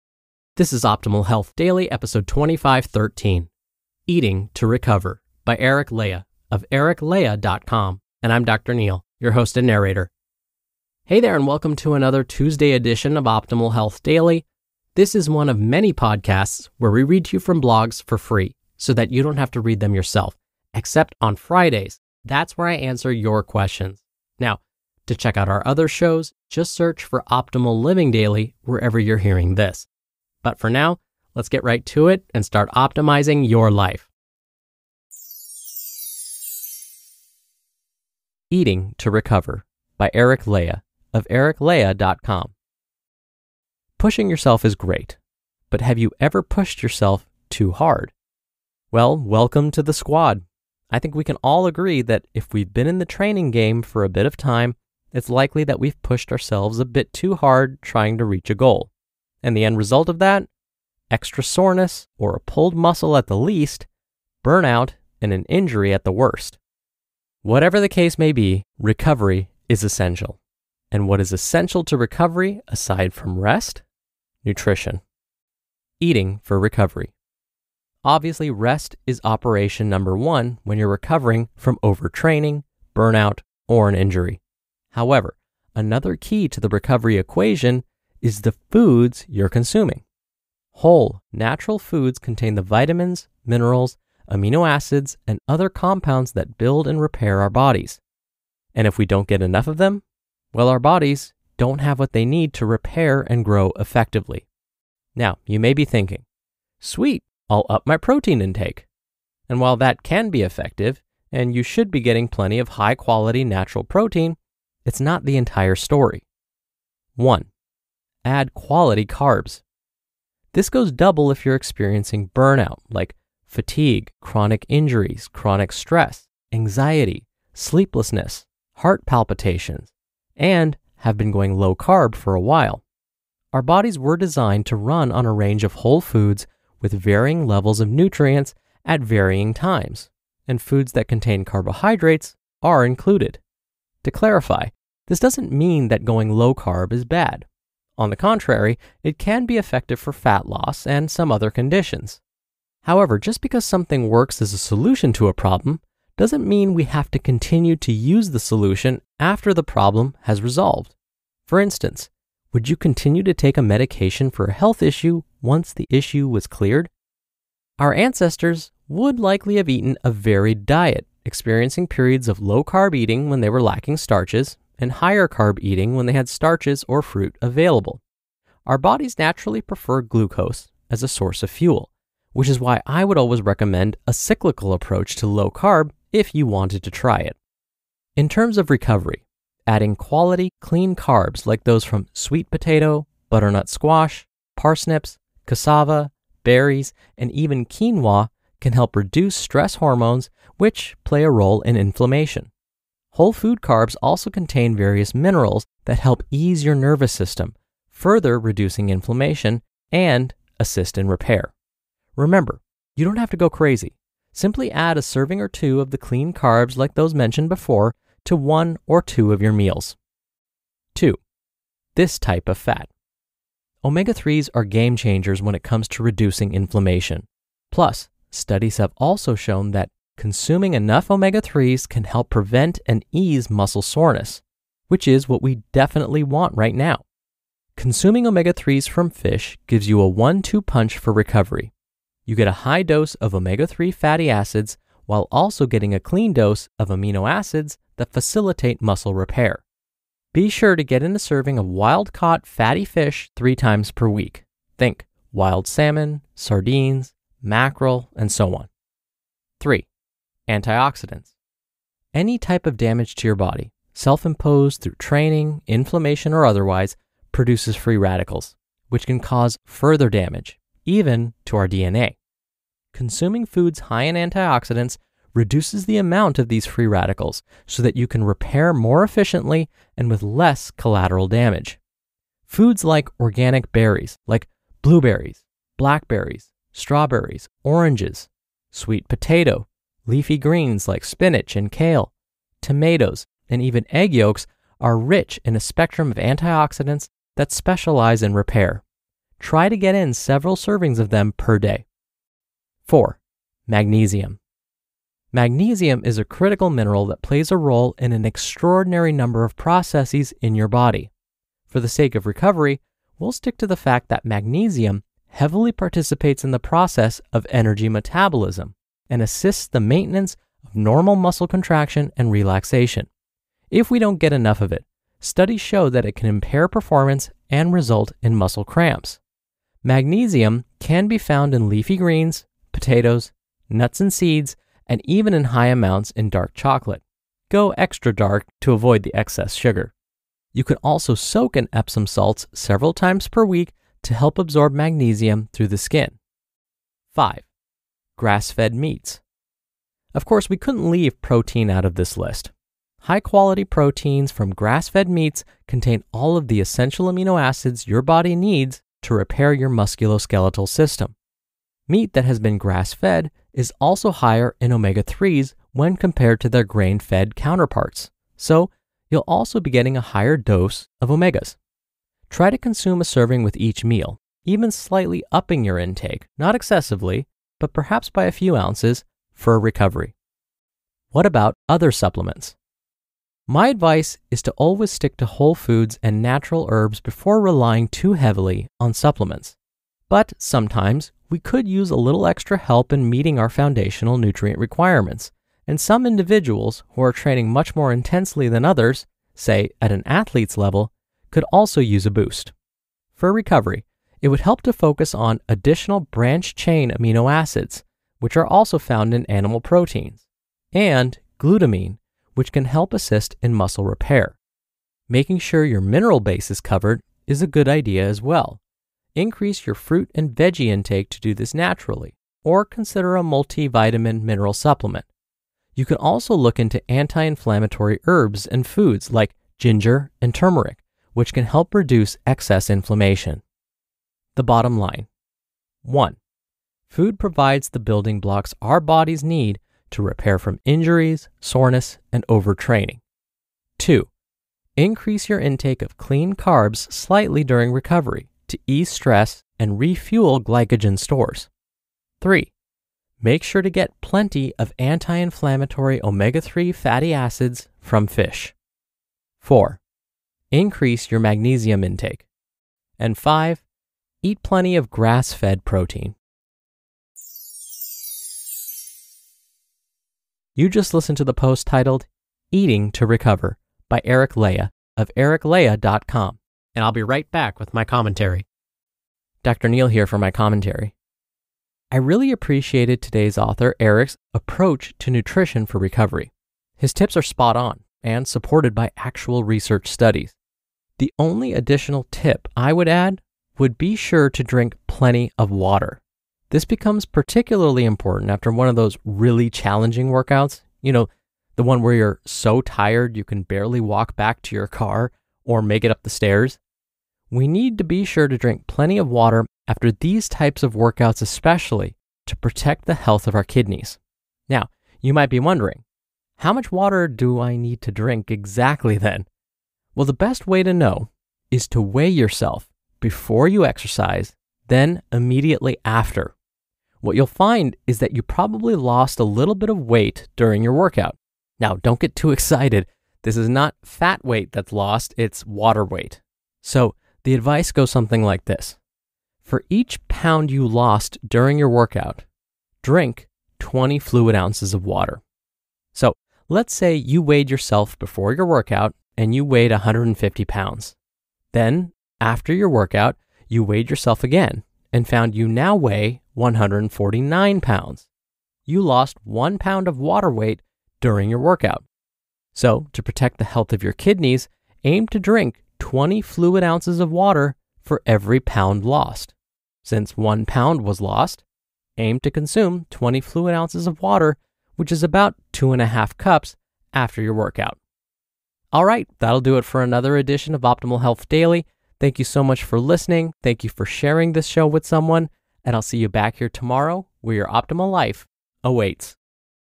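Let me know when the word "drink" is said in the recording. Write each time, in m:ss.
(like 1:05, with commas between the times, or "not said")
8:14, 8:28, 8:37, 9:02, 9:25.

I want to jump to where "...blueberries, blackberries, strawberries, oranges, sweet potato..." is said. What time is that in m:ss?
4:44.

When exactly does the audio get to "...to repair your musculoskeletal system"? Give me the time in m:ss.
5:59.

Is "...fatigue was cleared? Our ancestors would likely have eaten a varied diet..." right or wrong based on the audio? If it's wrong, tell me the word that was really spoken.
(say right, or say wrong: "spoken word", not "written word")
wrong: "issue", not "fatigue".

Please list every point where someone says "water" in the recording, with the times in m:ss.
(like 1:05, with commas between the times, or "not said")
8:15, 8:29, 8:36, 8:55, 9:04, 9:19, 9:27, 9:33.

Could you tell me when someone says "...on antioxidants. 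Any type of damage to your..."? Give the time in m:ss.
4:18.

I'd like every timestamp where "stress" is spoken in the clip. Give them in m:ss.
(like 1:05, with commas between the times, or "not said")
2:05, 3:19, 7:28.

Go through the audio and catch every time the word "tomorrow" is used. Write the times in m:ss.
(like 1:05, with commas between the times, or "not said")
9:46.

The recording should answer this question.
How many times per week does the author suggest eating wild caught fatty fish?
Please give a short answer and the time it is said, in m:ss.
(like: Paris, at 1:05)
three, at 4:13.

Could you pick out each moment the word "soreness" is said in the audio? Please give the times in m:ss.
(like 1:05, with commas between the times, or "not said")
1:01, 3:53, 7:21.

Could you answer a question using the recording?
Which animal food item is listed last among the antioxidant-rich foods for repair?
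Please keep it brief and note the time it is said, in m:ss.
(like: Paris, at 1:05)
egg yolks, at 4:53.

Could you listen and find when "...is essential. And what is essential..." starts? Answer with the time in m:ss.
1:09.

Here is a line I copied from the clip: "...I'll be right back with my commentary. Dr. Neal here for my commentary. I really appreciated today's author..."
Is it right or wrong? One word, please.
right.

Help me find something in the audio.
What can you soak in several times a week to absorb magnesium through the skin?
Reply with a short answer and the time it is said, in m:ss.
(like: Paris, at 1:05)
Epsom salts, at 5:41.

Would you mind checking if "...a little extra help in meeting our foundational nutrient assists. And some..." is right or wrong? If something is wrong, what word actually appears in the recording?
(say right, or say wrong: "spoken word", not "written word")
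wrong: "requirements", not "assists".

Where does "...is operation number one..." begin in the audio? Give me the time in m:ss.
1:19.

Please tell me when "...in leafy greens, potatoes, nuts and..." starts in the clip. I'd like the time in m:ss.
5:31.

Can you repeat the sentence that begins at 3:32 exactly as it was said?
Remember, you don't have to go crazy.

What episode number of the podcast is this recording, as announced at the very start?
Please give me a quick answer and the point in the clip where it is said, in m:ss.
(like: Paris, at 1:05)
2513, at 0:01.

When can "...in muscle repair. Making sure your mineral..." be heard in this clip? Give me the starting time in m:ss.
6:53.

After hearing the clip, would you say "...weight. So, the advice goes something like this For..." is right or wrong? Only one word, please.
right.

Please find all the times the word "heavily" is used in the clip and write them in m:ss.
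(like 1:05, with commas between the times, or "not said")
5:15, 6:28.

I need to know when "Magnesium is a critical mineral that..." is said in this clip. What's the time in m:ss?
5:05.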